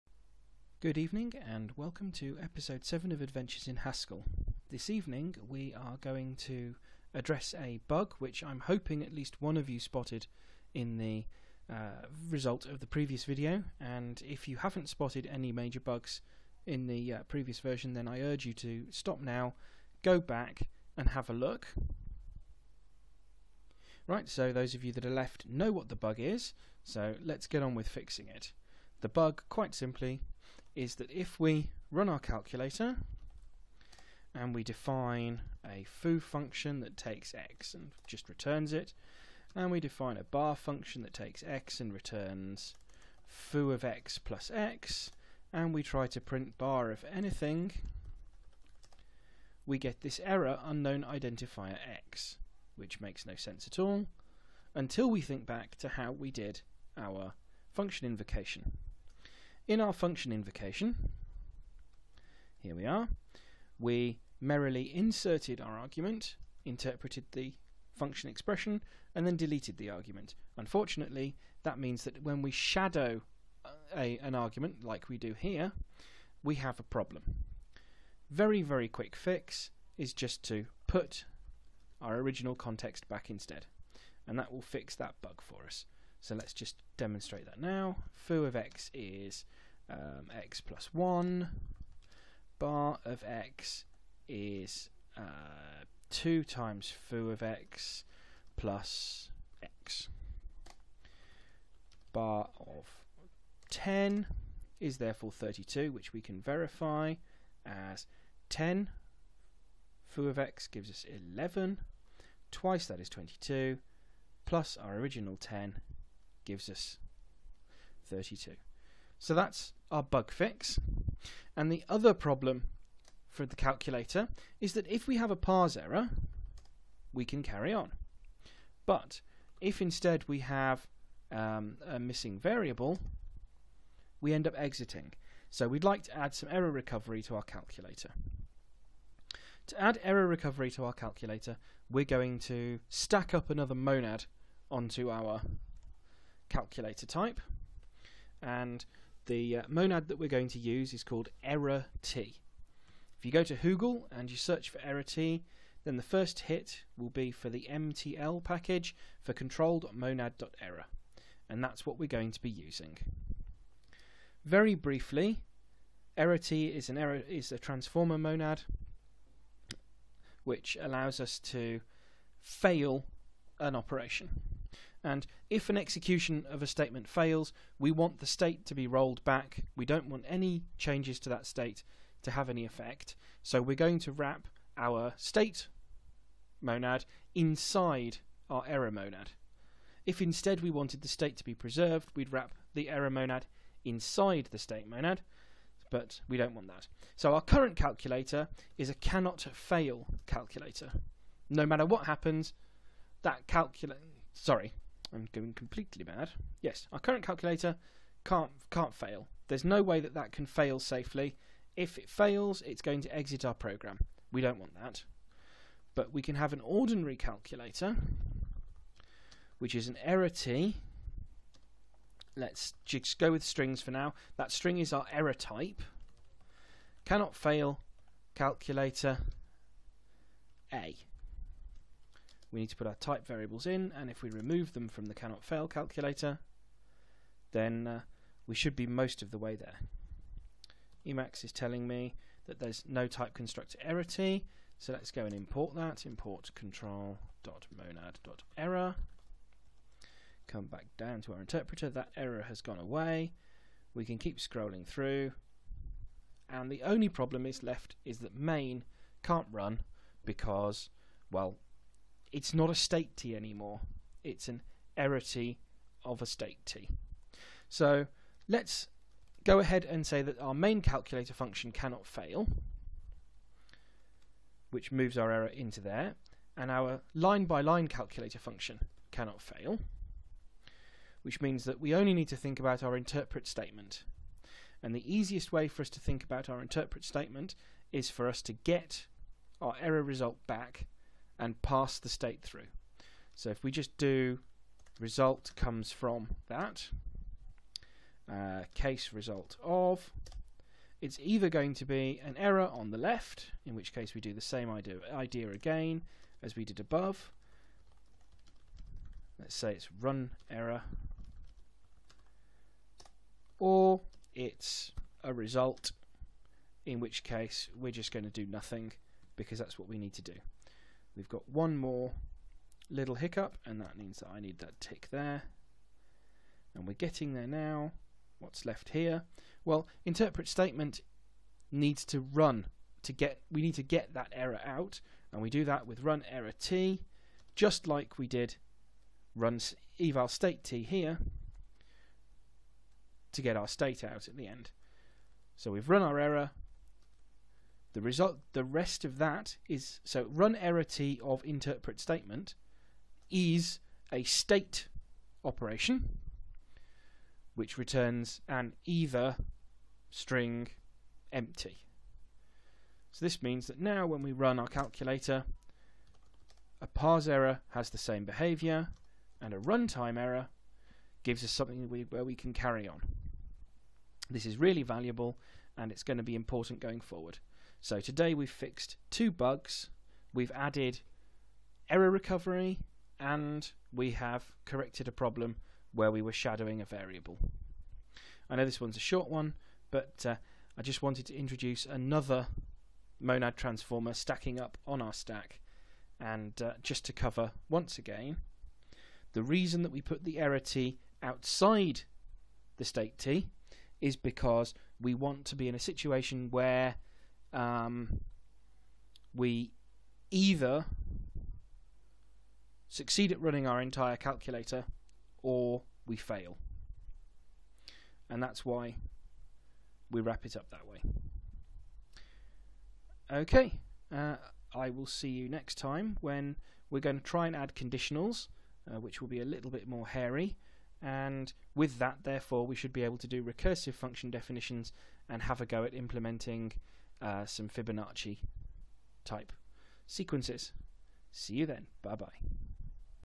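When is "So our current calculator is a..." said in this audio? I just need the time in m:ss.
3:17.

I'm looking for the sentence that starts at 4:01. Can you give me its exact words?
Emacs is telling me that there's no type constructor ErrorT, so let's go and import that.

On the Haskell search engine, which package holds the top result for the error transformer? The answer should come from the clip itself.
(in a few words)
mtl.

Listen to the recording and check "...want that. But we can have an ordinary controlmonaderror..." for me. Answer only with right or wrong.
wrong.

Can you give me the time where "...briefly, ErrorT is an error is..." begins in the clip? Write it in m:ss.
2:44.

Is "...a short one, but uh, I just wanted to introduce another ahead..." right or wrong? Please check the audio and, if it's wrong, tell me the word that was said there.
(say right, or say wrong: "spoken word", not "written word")
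wrong: "monad", not "ahead".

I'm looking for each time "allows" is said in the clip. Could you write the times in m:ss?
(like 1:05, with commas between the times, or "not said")
2:50.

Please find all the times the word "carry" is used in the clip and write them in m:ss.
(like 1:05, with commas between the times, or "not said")
2:07, 6:12.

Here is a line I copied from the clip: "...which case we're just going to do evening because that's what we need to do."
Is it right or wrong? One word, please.
wrong.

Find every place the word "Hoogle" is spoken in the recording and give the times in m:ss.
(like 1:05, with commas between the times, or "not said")
2:33.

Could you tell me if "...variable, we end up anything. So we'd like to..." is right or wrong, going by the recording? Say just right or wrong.
wrong.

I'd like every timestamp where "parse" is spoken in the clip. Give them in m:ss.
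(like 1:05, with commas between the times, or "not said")
2:05, 6:06.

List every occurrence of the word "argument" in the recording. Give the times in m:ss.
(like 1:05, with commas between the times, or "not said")
1:05, 1:09, 1:14.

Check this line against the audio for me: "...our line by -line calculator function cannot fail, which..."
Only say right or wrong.
right.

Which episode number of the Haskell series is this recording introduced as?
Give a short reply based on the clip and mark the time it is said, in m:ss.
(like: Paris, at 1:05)
7, at 0:02.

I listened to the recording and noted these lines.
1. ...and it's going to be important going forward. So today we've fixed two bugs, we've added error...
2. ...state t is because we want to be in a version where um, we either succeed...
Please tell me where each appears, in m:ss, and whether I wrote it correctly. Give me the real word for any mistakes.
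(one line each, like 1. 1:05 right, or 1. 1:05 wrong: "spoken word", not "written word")
1. 6:15 right
2. 6:42 wrong: "situation", not "version".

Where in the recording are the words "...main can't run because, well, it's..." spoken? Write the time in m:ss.
4:18.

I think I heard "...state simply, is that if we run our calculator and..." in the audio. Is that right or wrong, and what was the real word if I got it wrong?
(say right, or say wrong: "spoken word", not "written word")
wrong: "quite", not "state".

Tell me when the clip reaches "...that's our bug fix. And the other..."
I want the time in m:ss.
1:59.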